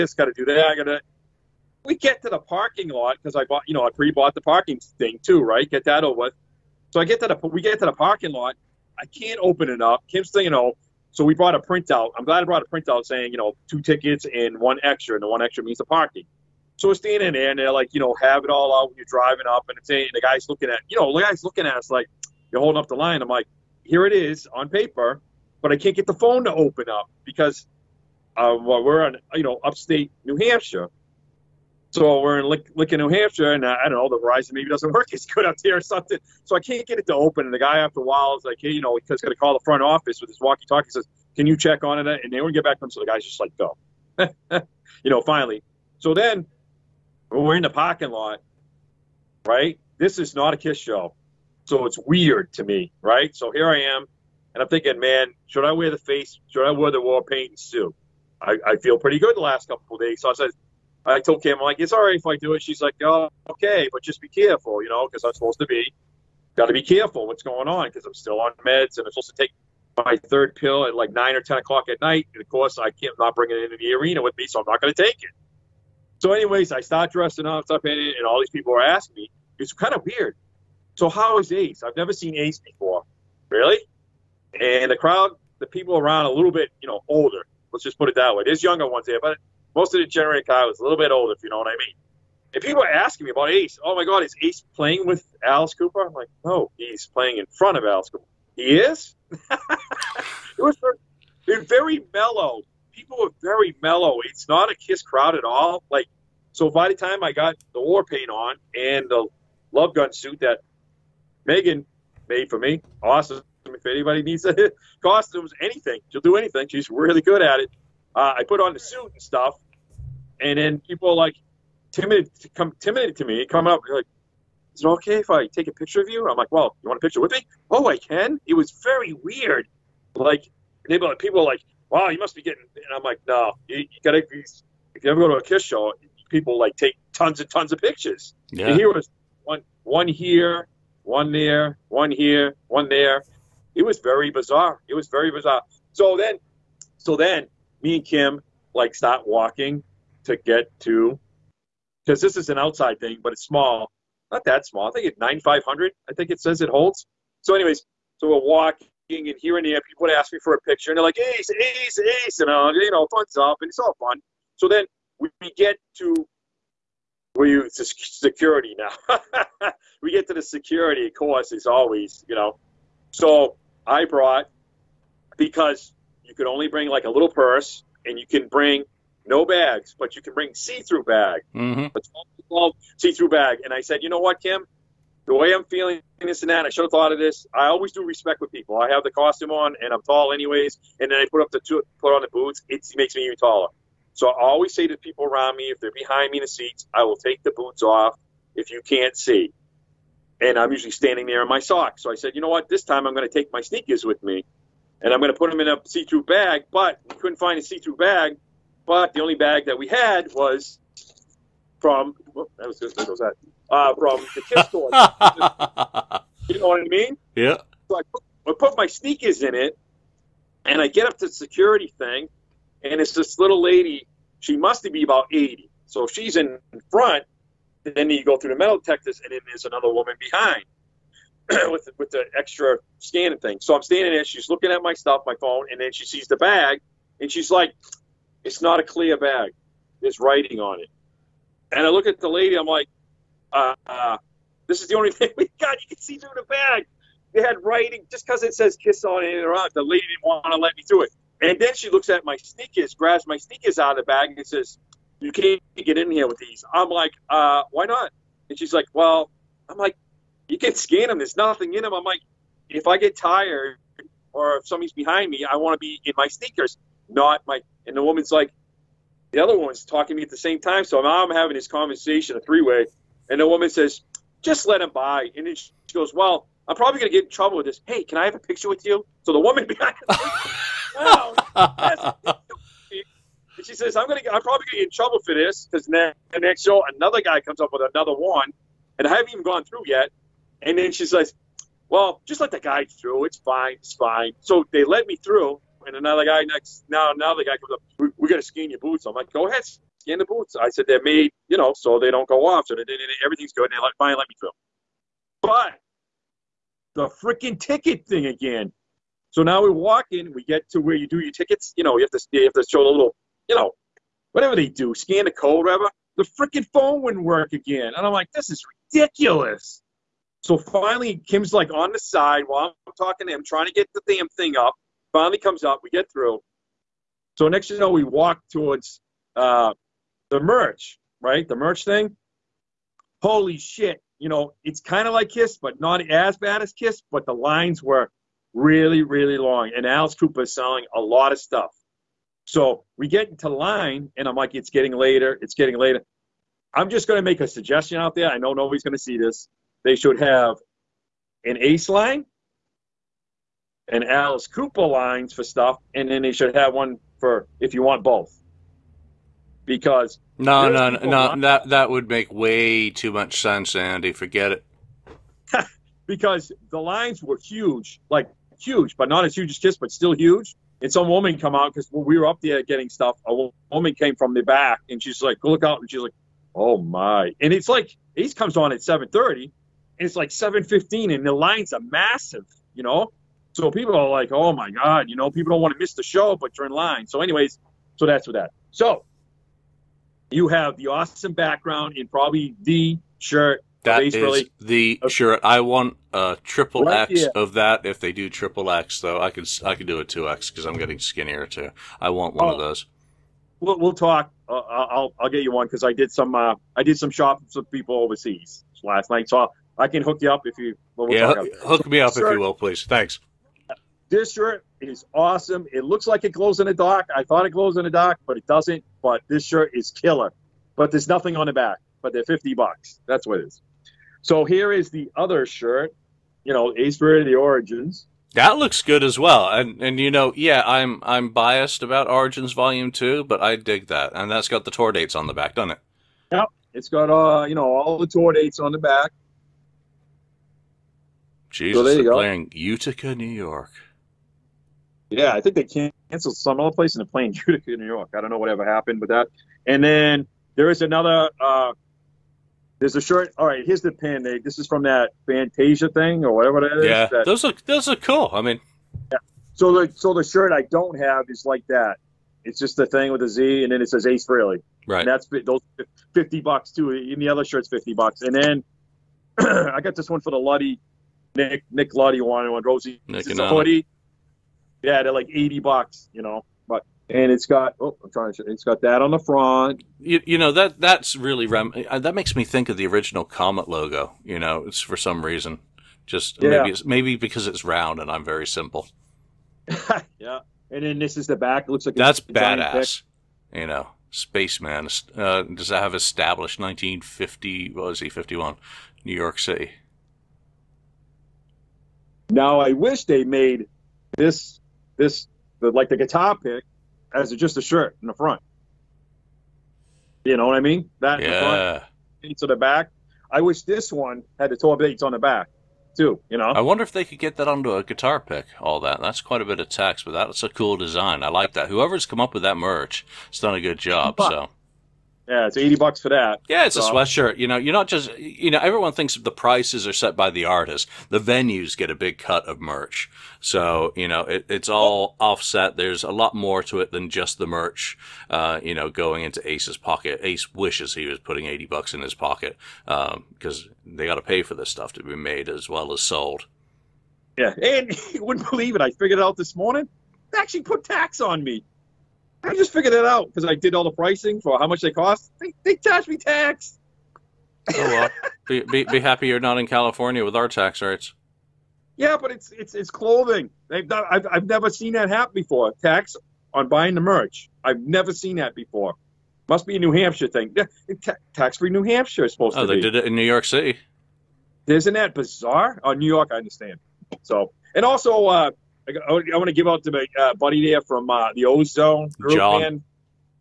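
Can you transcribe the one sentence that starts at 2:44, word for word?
So then we get to where you security now.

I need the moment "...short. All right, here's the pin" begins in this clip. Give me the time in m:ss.
7:33.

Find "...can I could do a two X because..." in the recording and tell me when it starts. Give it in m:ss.
6:39.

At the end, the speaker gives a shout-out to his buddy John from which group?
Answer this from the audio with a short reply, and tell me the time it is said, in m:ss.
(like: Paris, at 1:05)
Ozone group, at 9:41.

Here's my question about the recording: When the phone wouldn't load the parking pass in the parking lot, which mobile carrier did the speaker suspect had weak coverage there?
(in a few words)
Verizon.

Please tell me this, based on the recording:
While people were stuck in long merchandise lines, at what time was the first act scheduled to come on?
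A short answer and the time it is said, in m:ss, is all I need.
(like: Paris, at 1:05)
7:30, at 6:18.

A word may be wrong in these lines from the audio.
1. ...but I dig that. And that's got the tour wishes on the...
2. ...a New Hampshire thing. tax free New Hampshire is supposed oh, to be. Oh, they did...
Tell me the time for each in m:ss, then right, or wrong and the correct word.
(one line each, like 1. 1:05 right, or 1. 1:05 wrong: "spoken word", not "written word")
1. 7:13 wrong: "dates", not "wishes"
2. 9:29 right.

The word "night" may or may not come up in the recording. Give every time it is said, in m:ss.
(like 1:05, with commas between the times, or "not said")
1:12, 6:49.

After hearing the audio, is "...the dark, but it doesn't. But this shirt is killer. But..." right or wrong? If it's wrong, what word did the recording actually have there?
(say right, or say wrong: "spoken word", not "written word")
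right.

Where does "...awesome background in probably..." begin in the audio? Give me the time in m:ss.
6:30.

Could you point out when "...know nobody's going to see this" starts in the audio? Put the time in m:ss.
5:48.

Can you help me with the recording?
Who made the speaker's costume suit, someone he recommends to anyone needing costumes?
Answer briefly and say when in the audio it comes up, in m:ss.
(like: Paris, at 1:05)
Megan, at 1:51.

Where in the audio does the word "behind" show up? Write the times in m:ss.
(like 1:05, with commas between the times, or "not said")
3:15, 3:50, 4:24, 4:39.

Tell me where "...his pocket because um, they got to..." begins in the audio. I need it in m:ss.
9:02.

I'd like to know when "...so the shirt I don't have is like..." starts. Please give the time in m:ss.
7:39.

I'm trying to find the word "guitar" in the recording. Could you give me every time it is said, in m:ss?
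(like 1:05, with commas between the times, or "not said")
8:25, 8:37.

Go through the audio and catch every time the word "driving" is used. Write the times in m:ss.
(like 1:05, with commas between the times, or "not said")
0:19.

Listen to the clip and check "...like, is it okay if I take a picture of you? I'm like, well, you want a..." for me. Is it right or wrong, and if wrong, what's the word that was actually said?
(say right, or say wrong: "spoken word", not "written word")
right.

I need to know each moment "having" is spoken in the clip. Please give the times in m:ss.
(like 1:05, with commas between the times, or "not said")
4:31.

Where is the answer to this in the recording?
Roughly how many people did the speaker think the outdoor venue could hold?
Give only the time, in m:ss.
2:35.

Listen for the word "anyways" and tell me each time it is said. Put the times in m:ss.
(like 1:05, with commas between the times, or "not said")
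1:16, 2:37, 3:10, 6:27.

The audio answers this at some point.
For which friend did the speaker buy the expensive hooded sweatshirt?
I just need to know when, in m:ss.
7:51.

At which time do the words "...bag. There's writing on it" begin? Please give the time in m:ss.
3:59.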